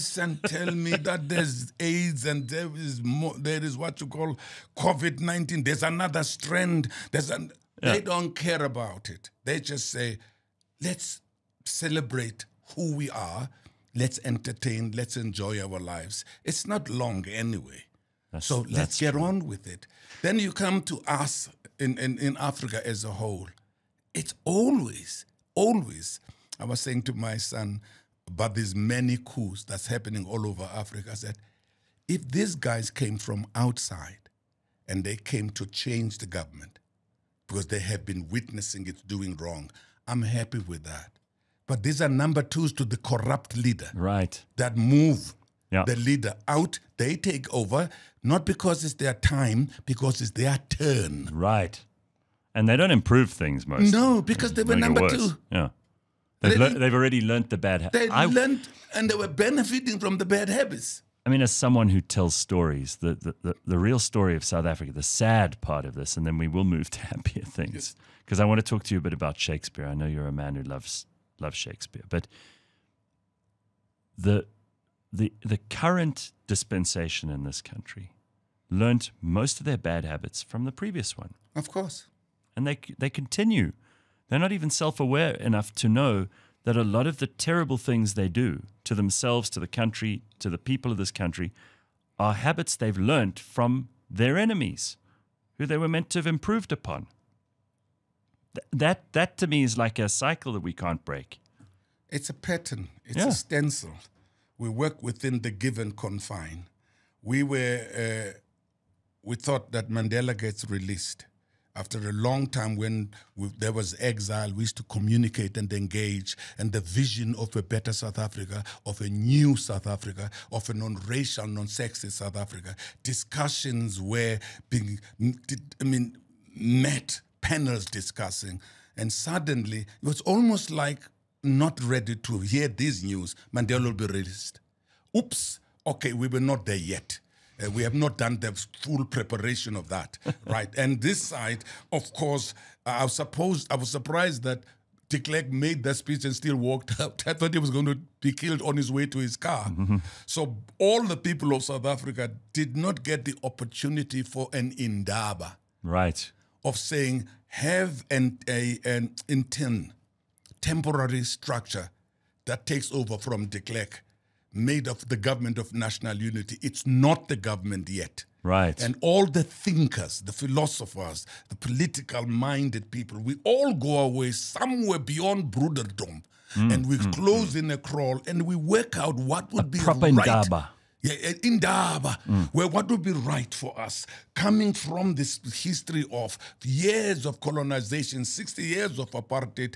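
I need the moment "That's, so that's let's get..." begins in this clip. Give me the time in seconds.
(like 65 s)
18 s.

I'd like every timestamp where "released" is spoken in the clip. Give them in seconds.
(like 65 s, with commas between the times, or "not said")
110 s, 134 s.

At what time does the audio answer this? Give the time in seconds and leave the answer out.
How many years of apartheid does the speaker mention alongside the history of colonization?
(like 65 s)
188 s.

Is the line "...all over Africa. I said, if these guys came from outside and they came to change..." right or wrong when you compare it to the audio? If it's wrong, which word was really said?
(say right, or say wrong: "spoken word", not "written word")
right.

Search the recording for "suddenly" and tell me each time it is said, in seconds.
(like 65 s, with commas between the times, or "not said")
129 s.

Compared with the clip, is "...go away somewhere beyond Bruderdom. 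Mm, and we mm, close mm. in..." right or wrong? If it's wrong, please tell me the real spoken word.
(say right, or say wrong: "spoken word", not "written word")
right.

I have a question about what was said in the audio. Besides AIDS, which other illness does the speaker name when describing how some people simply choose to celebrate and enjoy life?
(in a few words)
COVID 19.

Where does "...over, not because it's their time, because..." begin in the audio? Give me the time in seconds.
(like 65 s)
47 s.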